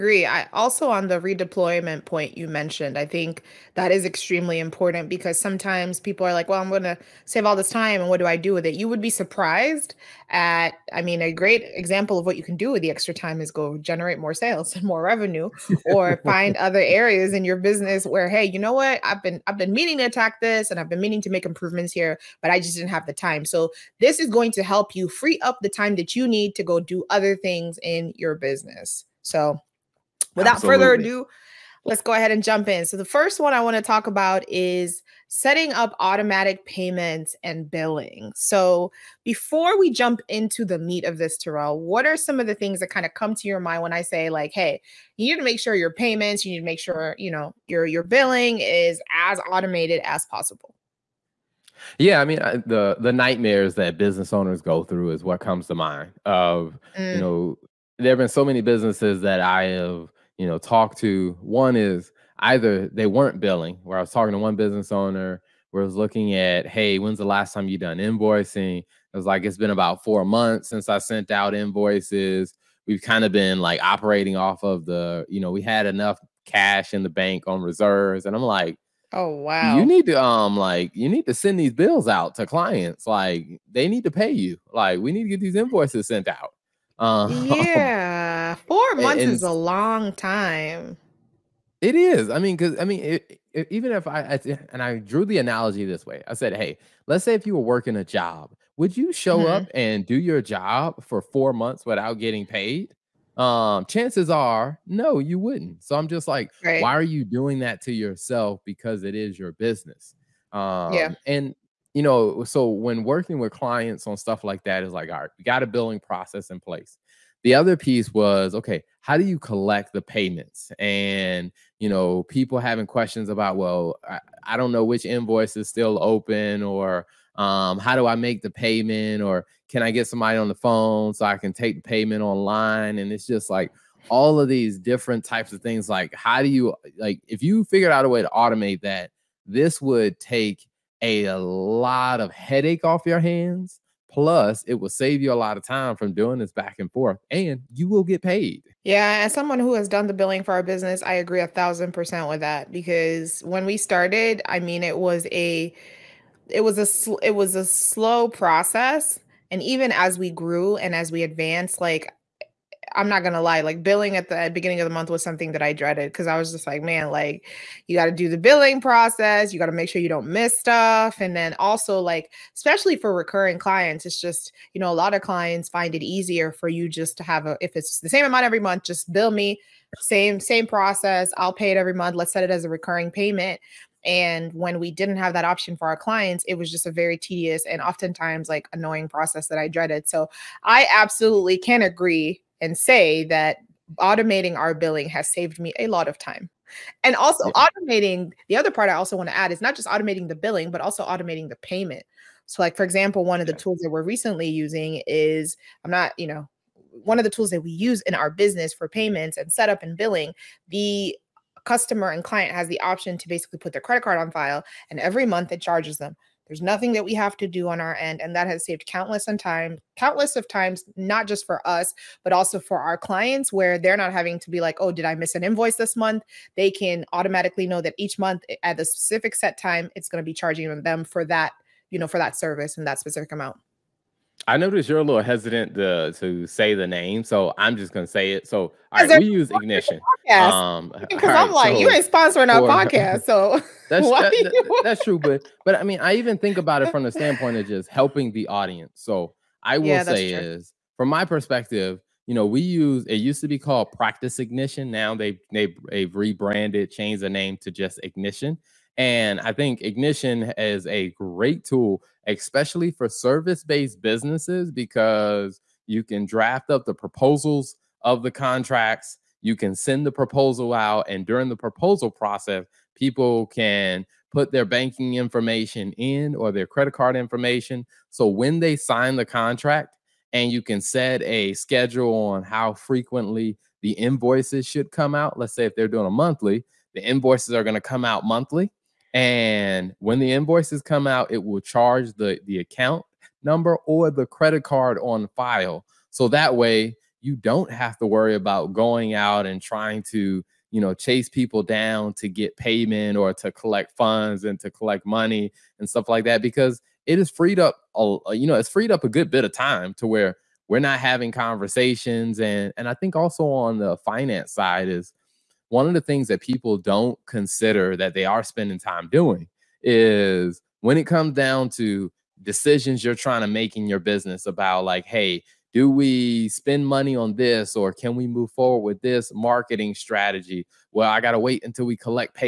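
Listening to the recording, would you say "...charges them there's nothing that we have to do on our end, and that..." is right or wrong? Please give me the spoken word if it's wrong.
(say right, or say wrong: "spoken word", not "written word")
right.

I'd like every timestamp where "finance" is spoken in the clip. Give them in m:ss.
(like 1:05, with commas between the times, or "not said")
5:13.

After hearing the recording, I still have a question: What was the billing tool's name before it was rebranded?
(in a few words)
Practice Ignition.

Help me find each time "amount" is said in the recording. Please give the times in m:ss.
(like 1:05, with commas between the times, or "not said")
2:58, 3:53.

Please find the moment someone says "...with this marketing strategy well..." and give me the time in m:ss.
5:28.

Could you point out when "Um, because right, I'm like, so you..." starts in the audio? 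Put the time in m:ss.
4:00.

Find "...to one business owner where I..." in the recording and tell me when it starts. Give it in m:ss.
1:04.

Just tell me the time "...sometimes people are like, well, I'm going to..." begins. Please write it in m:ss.
0:05.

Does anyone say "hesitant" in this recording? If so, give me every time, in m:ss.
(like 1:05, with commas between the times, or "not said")
3:55.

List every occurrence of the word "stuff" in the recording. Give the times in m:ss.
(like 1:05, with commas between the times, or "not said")
1:54, 2:50, 5:05.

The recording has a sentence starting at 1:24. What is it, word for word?
Like we need to get these invoices sent out.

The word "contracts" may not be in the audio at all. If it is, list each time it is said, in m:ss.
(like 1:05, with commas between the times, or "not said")
4:28, 4:39.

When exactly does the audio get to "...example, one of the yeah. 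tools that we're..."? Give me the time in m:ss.
3:22.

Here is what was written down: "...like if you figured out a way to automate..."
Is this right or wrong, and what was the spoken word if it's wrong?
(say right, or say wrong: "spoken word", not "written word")
right.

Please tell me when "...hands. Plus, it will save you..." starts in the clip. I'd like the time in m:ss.
2:23.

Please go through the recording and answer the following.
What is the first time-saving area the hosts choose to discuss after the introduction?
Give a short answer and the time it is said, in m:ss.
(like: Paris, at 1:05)
automatic payments and billing, at 0:35.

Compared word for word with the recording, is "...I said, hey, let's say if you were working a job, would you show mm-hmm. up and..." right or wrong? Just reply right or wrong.
right.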